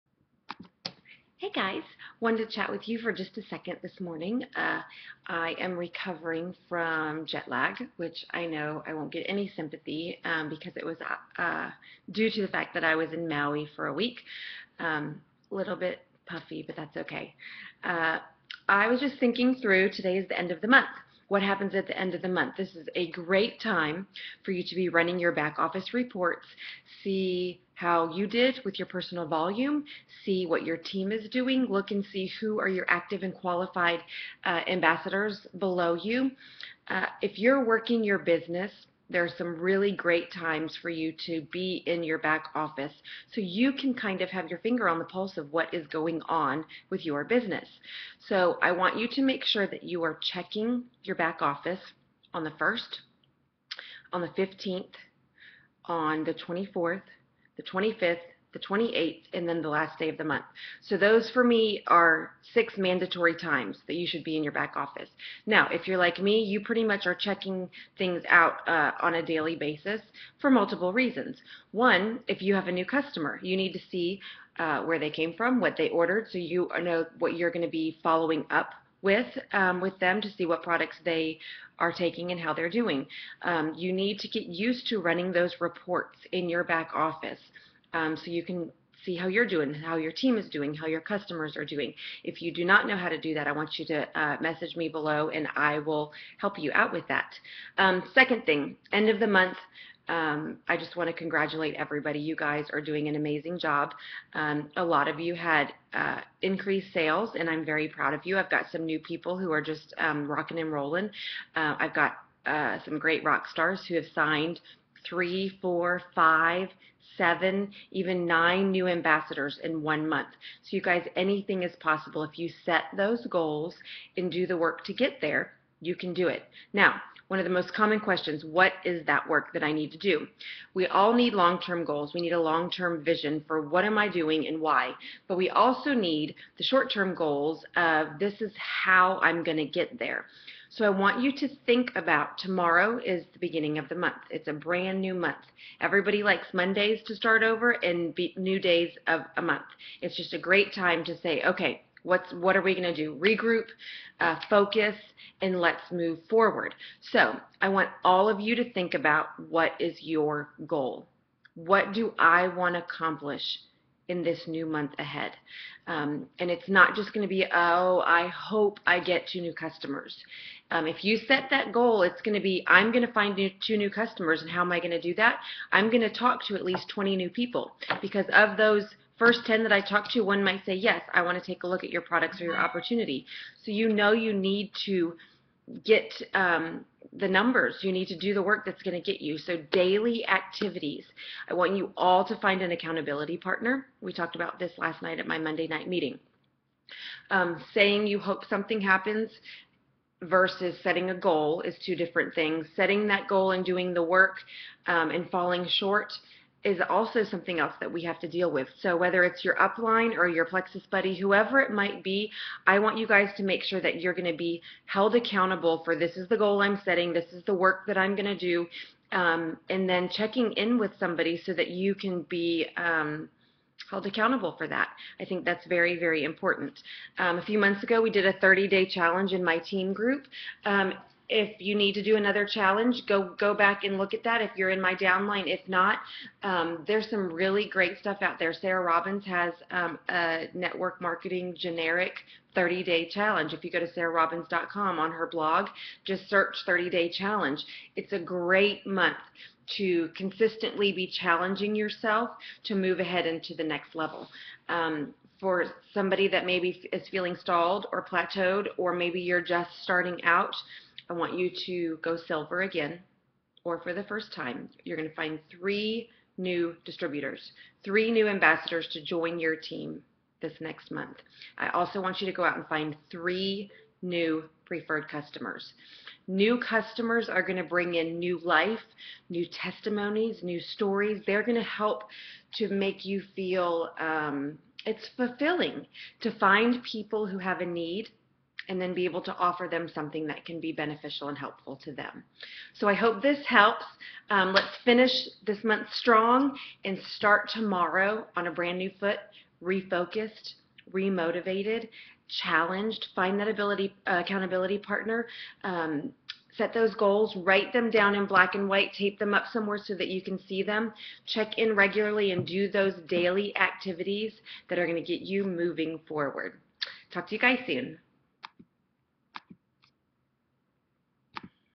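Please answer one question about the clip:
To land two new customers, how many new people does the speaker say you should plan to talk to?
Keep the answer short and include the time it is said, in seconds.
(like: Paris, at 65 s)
20, at 176 s.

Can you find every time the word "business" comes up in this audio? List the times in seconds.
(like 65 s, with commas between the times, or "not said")
38 s, 47 s.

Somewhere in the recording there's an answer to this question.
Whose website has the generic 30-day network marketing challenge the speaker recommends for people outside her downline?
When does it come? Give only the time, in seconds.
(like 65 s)
238 s.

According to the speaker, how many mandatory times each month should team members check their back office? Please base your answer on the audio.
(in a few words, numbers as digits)
6.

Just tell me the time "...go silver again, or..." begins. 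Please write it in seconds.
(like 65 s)
262 s.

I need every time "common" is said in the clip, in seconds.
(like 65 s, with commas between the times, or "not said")
127 s.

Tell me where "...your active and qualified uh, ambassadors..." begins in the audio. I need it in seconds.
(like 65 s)
32 s.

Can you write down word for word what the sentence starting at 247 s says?
It's a great month to consistently be challenging yourself to move ahead into the next level.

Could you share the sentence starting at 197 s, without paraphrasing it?
Um, saying you hope something happens versus setting a goal is two different things.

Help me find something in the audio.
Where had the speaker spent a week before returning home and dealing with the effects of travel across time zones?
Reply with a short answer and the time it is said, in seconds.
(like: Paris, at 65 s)
Maui, at 13 s.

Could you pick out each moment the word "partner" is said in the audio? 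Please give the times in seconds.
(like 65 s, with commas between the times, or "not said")
193 s, 304 s.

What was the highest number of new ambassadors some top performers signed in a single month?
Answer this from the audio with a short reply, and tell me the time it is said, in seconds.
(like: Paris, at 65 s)
9, at 118 s.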